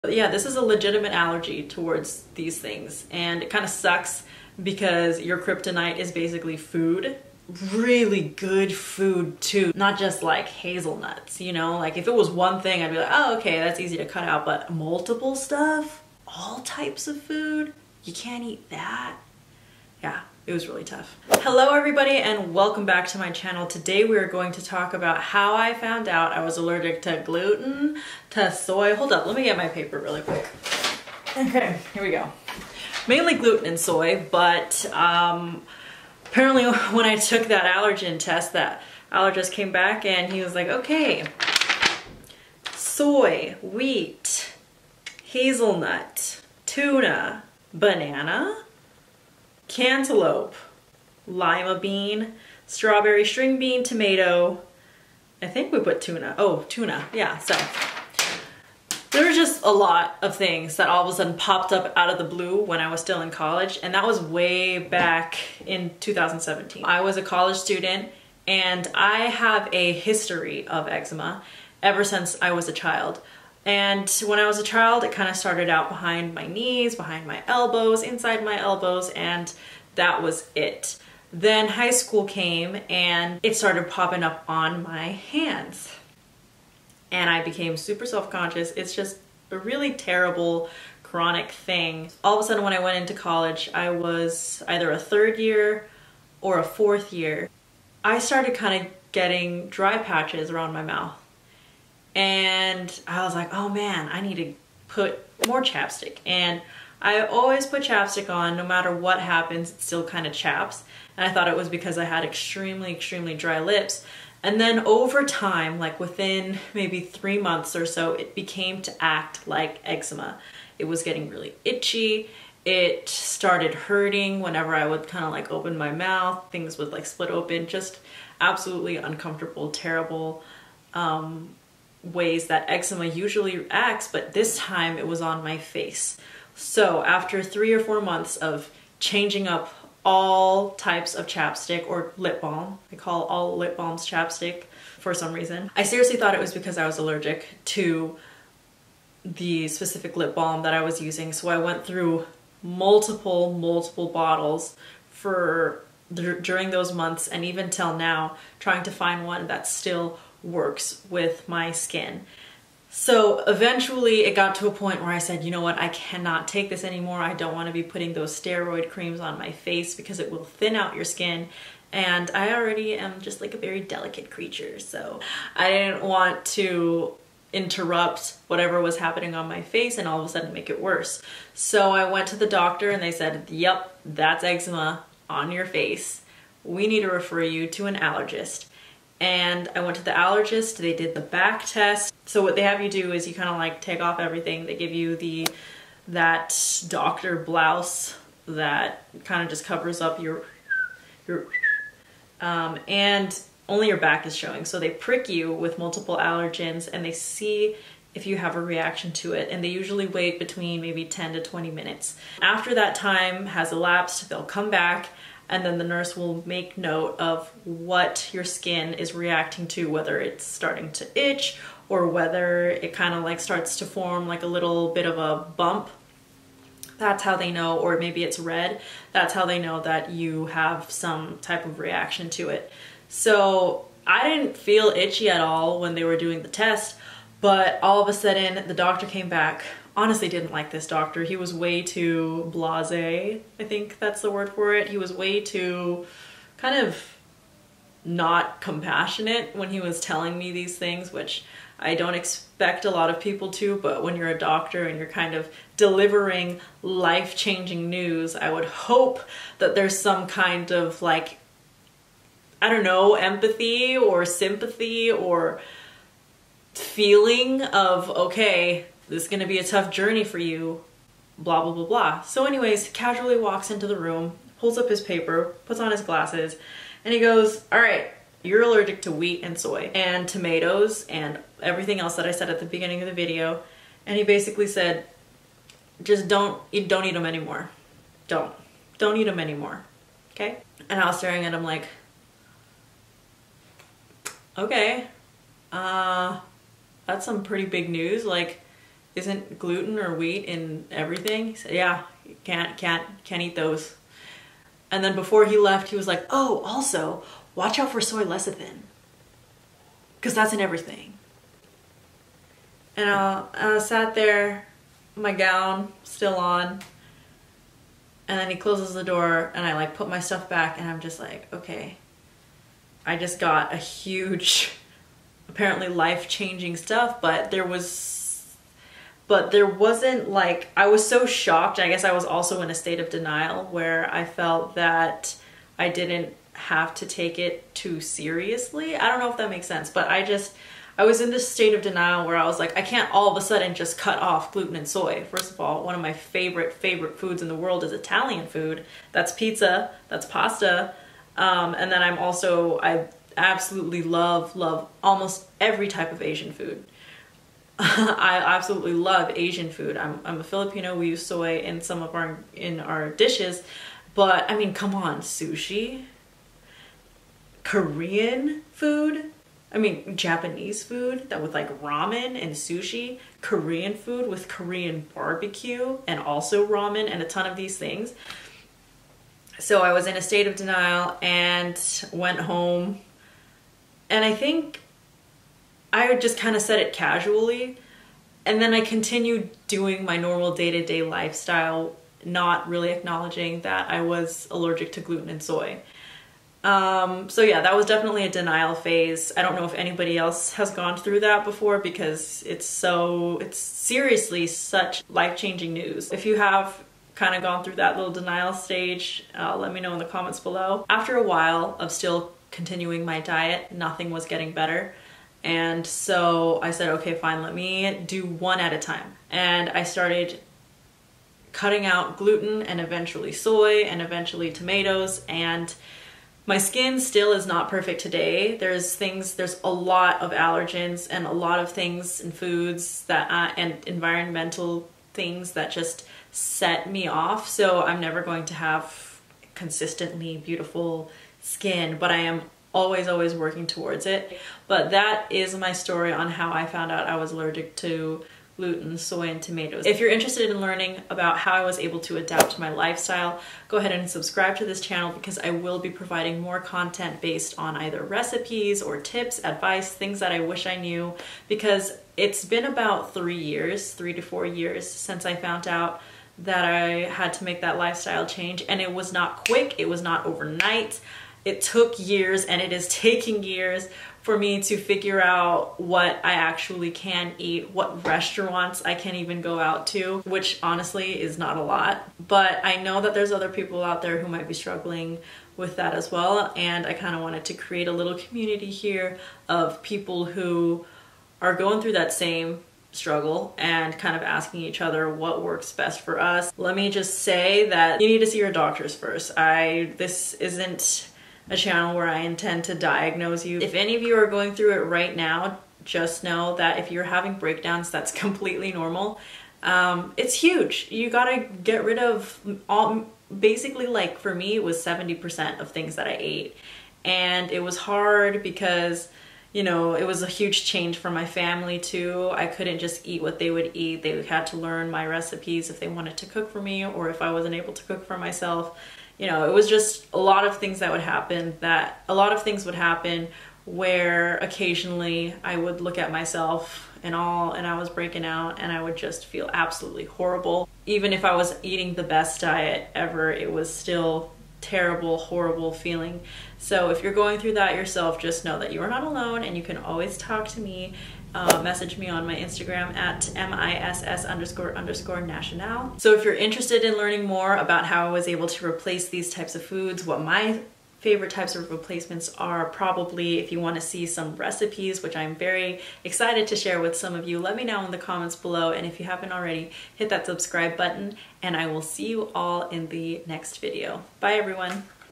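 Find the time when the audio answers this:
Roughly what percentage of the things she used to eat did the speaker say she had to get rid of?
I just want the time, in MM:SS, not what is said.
08:34.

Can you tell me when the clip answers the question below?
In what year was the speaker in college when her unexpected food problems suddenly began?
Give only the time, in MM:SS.
01:06.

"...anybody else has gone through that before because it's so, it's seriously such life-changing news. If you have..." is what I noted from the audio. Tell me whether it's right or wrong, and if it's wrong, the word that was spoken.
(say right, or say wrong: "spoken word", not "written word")
right.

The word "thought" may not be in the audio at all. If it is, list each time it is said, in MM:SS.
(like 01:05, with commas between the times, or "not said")
01:51, 02:26.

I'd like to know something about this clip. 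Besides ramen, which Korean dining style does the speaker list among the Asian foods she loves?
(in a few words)
Korean barbecue.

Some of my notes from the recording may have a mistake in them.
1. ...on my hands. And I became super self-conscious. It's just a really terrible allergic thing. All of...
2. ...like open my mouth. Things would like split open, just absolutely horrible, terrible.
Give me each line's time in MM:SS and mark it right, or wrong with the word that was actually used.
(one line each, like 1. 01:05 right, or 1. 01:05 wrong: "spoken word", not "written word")
1. 01:24 wrong: "chronic", not "allergic"
2. 02:05 wrong: "uncomfortable", not "horrible".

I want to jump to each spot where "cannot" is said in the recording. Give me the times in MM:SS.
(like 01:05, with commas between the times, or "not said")
02:45.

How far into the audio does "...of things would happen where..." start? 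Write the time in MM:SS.
08:52.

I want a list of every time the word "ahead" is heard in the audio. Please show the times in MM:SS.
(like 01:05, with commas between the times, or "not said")
07:33.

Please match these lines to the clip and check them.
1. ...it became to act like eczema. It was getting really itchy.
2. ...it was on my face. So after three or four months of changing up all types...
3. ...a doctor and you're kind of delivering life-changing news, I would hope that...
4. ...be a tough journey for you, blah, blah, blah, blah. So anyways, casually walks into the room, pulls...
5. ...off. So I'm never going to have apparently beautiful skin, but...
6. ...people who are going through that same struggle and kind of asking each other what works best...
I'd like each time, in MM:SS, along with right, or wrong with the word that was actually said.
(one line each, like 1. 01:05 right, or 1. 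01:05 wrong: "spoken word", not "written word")
1. 01:58 right
2. 02:14 right
3. 04:14 right
4. 04:29 right
5. 07:17 wrong: "consistently", not "apparently"
6. 08:09 right.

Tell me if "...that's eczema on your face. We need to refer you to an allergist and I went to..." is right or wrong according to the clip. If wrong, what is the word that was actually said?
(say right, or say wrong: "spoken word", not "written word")
right.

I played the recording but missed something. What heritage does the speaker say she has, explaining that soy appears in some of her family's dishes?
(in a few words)
Filipino.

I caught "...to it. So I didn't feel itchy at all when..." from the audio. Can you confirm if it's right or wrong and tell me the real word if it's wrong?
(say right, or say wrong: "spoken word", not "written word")
right.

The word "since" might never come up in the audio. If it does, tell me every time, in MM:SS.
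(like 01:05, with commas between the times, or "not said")
01:12, 07:44.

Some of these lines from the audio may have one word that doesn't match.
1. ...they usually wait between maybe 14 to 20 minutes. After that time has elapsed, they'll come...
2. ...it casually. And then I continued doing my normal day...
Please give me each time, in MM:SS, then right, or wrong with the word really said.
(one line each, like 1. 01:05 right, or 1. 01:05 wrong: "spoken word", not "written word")
1. 03:29 wrong: "10", not "14"
2. 06:26 right.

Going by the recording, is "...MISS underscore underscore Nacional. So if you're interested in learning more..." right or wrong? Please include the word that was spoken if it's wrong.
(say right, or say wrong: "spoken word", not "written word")
right.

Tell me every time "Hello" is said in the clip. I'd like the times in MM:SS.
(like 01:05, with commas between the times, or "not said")
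00:21.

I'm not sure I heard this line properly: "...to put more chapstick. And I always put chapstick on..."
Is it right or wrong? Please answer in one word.
right.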